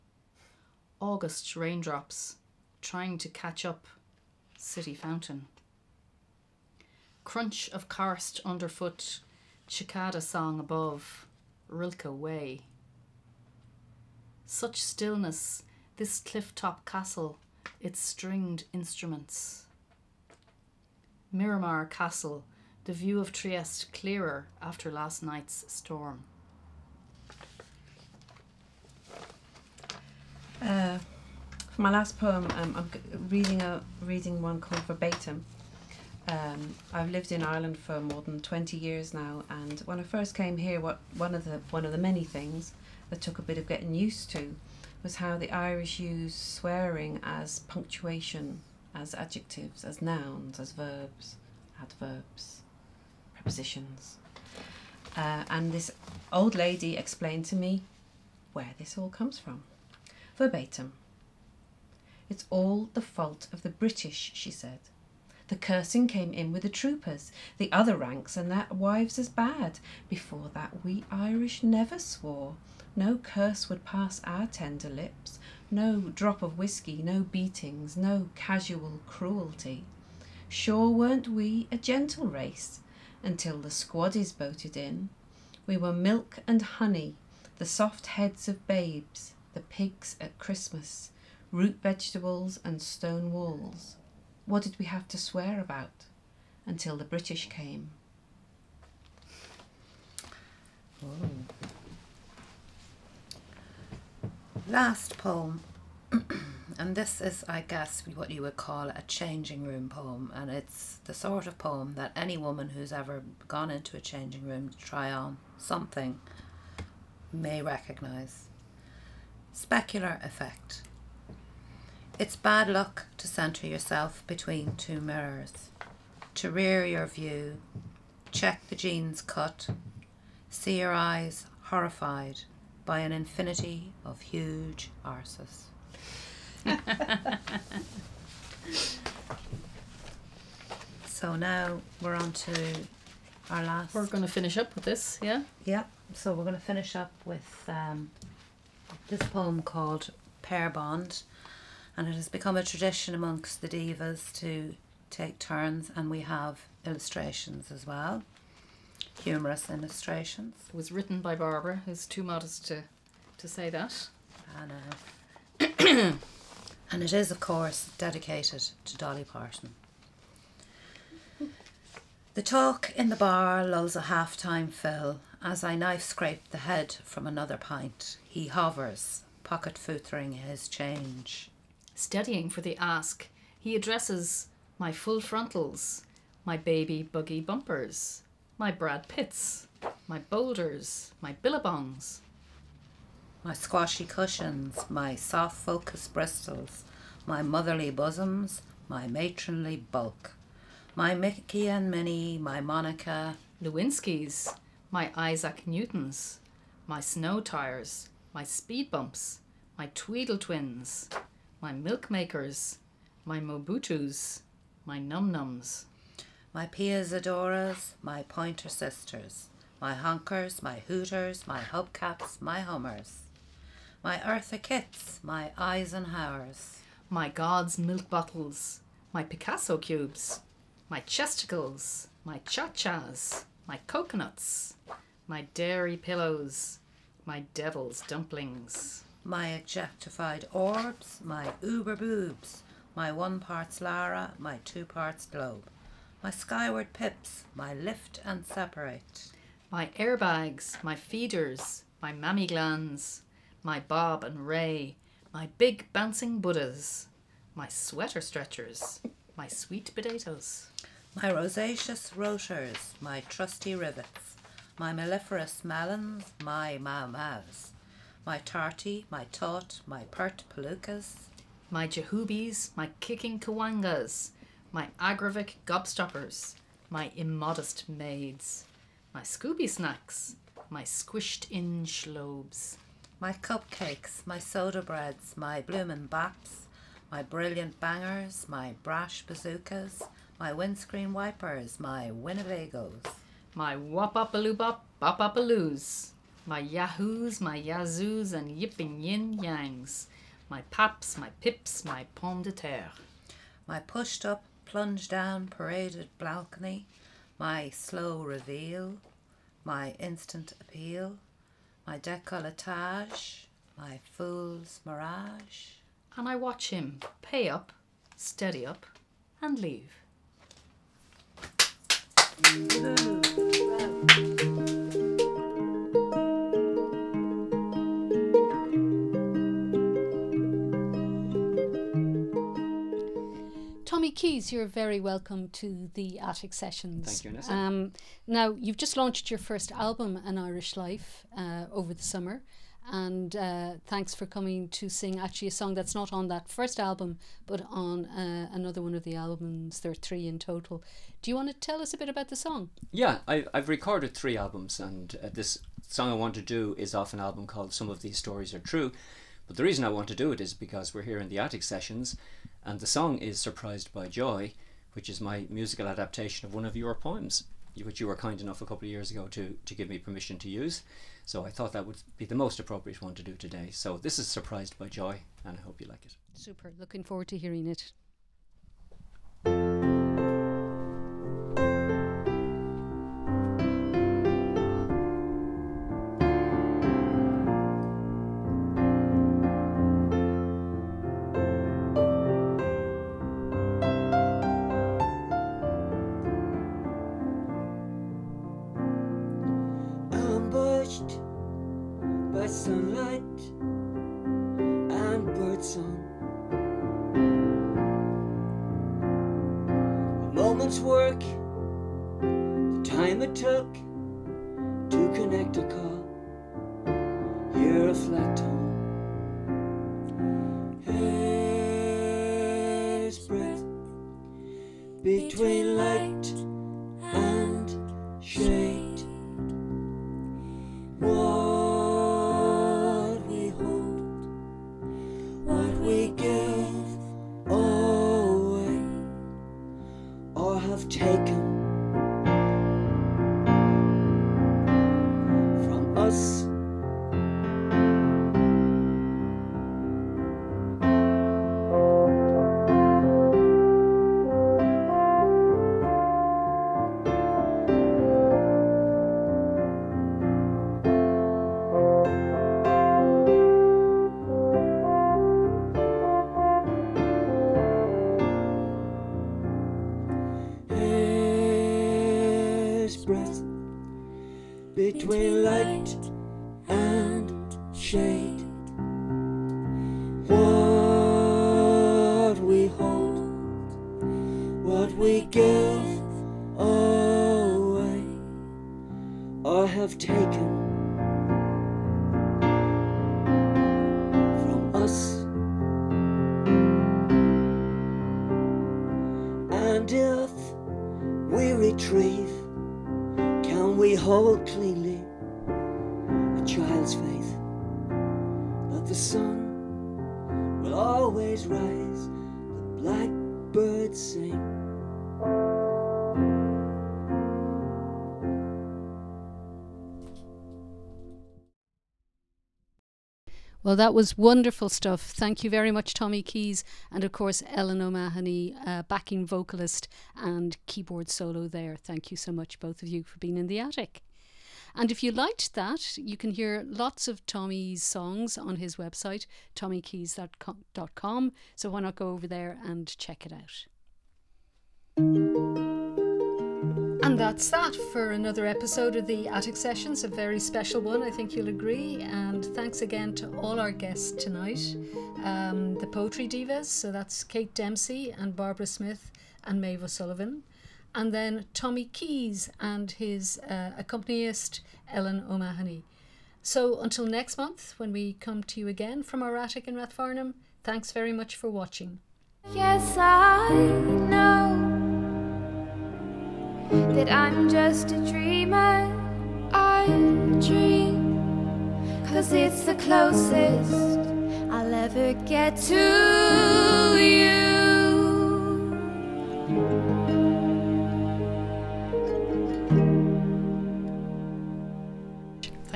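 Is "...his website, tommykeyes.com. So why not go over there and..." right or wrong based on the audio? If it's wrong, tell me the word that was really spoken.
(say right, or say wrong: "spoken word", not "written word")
right.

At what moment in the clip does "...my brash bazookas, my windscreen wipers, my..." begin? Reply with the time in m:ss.
4:48.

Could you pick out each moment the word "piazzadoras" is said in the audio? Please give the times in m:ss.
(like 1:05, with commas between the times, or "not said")
3:36.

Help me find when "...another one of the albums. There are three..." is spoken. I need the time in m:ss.
5:48.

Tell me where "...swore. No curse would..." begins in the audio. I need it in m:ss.
1:11.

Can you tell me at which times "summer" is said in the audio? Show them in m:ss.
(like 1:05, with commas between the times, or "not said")
5:42.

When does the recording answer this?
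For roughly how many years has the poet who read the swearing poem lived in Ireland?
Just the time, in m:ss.
0:38.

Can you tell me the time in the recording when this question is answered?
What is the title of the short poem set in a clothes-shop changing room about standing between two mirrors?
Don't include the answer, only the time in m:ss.
1:59.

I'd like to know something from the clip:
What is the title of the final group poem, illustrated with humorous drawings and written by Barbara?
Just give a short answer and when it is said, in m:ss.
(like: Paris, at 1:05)
Pair Bond, at 2:30.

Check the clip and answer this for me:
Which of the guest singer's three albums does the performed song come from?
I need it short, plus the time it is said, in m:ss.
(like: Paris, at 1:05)
Some of These Stories Are True, at 5:57.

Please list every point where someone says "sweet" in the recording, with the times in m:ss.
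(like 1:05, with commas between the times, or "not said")
4:19.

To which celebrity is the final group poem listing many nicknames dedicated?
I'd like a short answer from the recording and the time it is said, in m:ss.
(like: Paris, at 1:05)
Dolly Parton, at 2:48.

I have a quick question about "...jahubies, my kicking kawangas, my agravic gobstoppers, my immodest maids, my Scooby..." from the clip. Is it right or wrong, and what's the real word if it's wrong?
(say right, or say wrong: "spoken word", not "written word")
right.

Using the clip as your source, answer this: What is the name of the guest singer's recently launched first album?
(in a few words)
An Irish Life.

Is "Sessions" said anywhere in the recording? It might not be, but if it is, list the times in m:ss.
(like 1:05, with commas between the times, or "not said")
5:36, 6:01, 9:09.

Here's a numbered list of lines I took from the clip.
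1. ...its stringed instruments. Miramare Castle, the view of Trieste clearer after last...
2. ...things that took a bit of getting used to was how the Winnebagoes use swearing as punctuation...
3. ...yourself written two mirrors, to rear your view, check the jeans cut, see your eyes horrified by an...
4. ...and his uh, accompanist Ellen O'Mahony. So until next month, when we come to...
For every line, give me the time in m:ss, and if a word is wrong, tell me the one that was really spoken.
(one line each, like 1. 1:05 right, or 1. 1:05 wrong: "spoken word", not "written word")
1. 0:17 right
2. 0:42 wrong: "Irish", not "Winnebagoes"
3. 2:03 wrong: "between", not "written"
4. 9:22 right.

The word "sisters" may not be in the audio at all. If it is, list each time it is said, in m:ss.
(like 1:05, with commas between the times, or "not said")
3:38.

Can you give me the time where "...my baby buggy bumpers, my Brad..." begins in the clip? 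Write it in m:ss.
3:06.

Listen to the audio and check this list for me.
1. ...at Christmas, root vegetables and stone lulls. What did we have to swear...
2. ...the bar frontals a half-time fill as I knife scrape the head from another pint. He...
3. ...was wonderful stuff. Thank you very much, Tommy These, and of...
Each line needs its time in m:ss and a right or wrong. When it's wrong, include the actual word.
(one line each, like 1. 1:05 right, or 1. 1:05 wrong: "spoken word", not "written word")
1. 1:30 wrong: "walls", not "lulls"
2. 2:53 wrong: "lulls", not "frontals"
3. 8:43 wrong: "Keyes", not "These".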